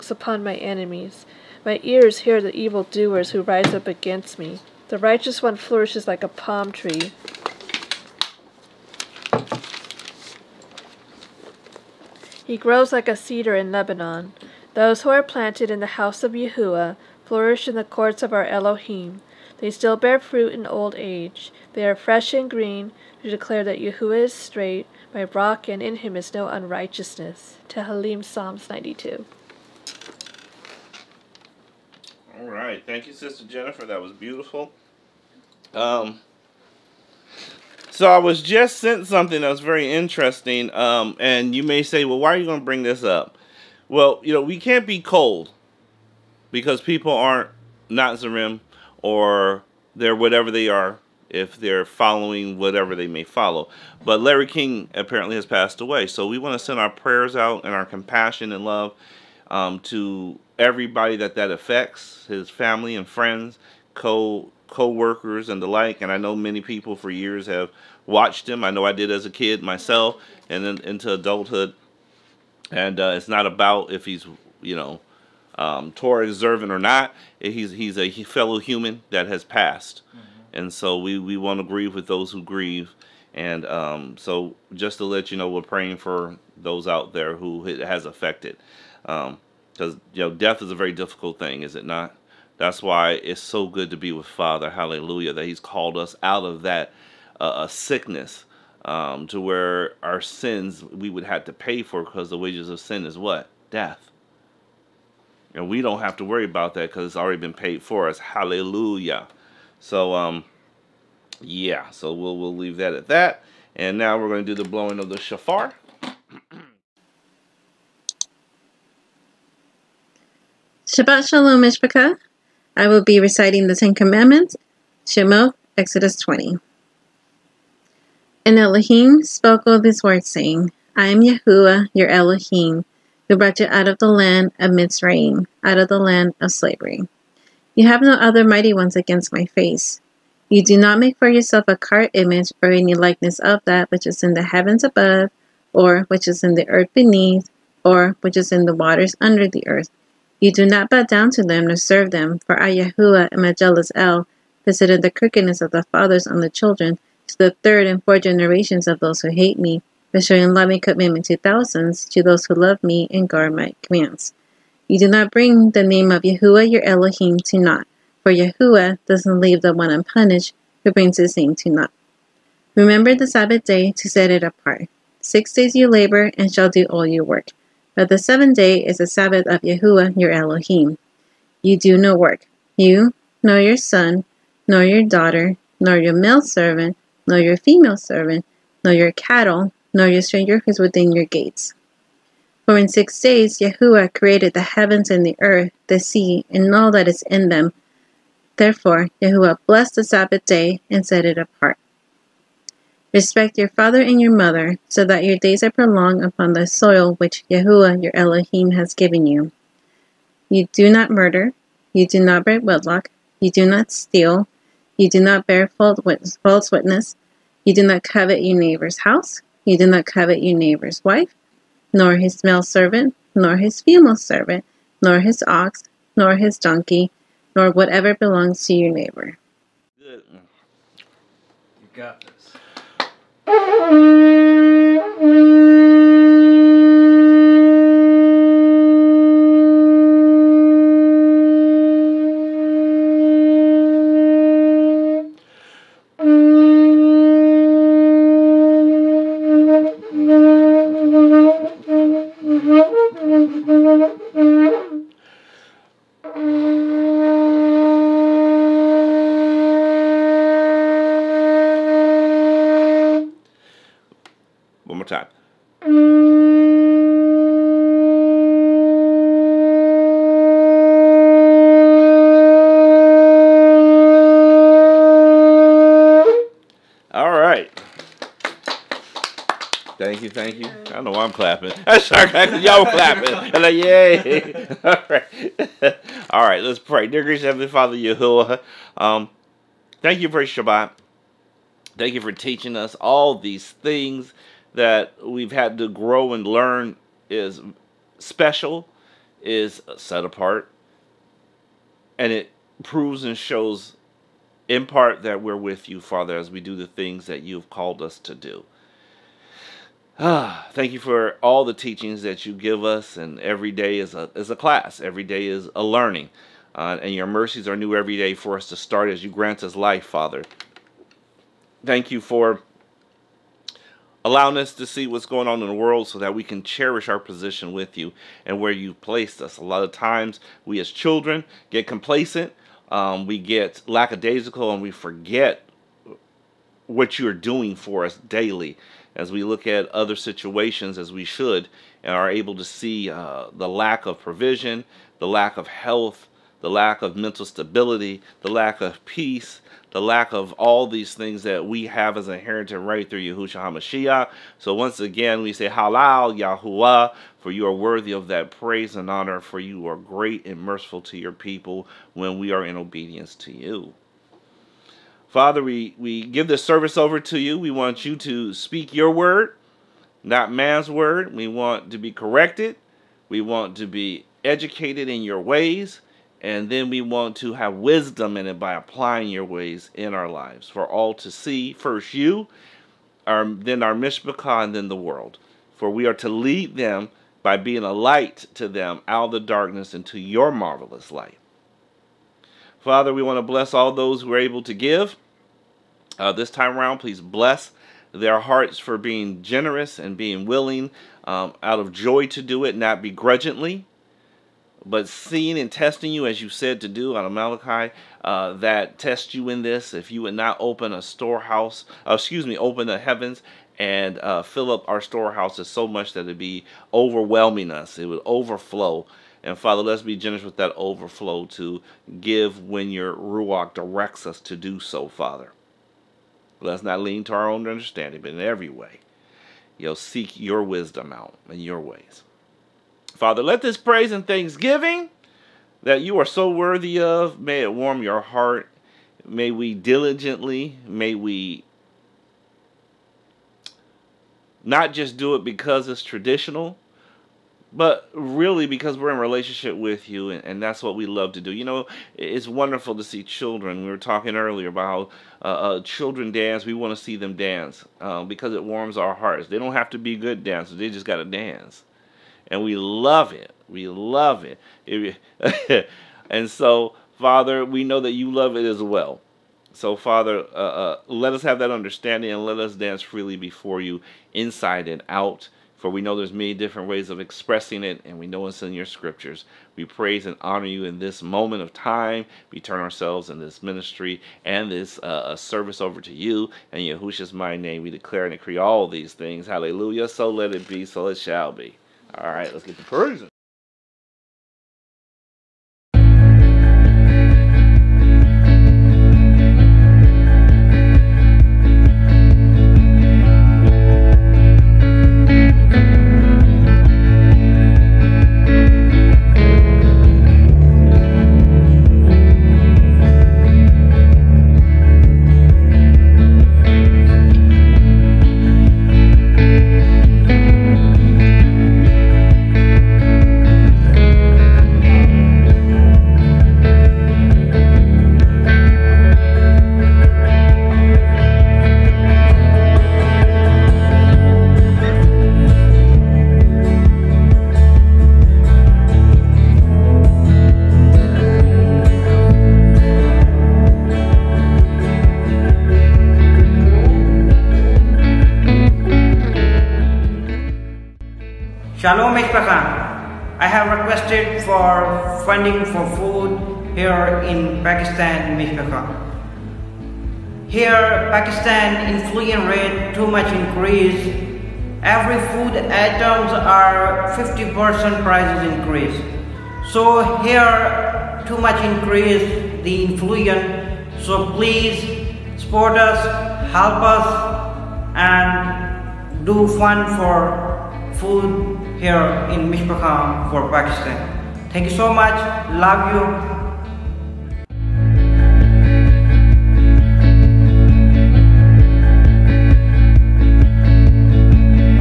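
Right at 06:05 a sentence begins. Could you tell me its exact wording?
Father, we, we give this service over to you.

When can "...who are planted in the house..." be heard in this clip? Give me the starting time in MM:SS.
00:15.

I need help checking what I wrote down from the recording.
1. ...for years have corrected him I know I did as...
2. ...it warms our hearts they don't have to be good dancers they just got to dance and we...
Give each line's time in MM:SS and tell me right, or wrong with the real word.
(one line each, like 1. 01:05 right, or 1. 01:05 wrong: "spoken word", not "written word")
1. 01:06 wrong: "watched", not "corrected"
2. 07:38 right.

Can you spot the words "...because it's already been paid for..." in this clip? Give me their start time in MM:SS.
01:46.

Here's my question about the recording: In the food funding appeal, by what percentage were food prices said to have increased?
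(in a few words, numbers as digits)
50%.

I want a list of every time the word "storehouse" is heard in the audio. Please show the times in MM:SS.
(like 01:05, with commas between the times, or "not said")
06:51, 06:55.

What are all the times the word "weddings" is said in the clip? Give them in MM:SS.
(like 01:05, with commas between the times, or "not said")
not said.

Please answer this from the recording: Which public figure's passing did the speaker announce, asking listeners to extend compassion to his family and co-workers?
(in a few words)
Larry King.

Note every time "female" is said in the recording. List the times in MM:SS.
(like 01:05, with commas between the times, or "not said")
03:07, 03:43.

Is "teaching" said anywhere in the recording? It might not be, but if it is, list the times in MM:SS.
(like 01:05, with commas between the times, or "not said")
04:52, 05:11.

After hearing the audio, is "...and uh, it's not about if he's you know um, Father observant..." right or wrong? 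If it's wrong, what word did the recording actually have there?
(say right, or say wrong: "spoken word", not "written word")
wrong: "Torah", not "Father".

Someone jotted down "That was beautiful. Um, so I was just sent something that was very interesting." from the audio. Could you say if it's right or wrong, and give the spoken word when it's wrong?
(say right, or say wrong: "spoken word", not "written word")
right.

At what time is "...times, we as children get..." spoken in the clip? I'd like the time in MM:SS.
05:29.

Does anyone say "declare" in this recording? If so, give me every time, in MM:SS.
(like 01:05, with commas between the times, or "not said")
00:23, 08:07.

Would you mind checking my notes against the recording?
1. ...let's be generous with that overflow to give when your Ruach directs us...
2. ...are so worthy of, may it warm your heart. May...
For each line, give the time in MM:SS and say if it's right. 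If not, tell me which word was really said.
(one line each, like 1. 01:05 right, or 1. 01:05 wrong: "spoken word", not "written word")
1. 06:59 right
2. 07:16 right.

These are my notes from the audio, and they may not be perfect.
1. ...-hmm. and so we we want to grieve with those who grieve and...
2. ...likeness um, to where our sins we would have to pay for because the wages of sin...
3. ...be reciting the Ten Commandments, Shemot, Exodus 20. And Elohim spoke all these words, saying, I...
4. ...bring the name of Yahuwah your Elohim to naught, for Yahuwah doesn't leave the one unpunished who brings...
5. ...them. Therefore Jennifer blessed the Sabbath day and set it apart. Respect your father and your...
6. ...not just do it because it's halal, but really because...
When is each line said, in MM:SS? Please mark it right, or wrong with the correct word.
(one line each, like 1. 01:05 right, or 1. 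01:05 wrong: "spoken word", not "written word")
1. 01:20 right
2. 01:37 wrong: "sickness", not "likeness"
3. 02:03 right
4. 02:45 right
5. 03:17 wrong: "Yahuwah", not "Jennifer"
6. 07:24 wrong: "traditional", not "halal".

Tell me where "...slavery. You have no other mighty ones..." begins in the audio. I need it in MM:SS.
02:16.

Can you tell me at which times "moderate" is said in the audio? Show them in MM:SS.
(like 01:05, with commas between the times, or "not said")
not said.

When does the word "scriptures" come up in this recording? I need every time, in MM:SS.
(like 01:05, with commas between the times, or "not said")
07:58.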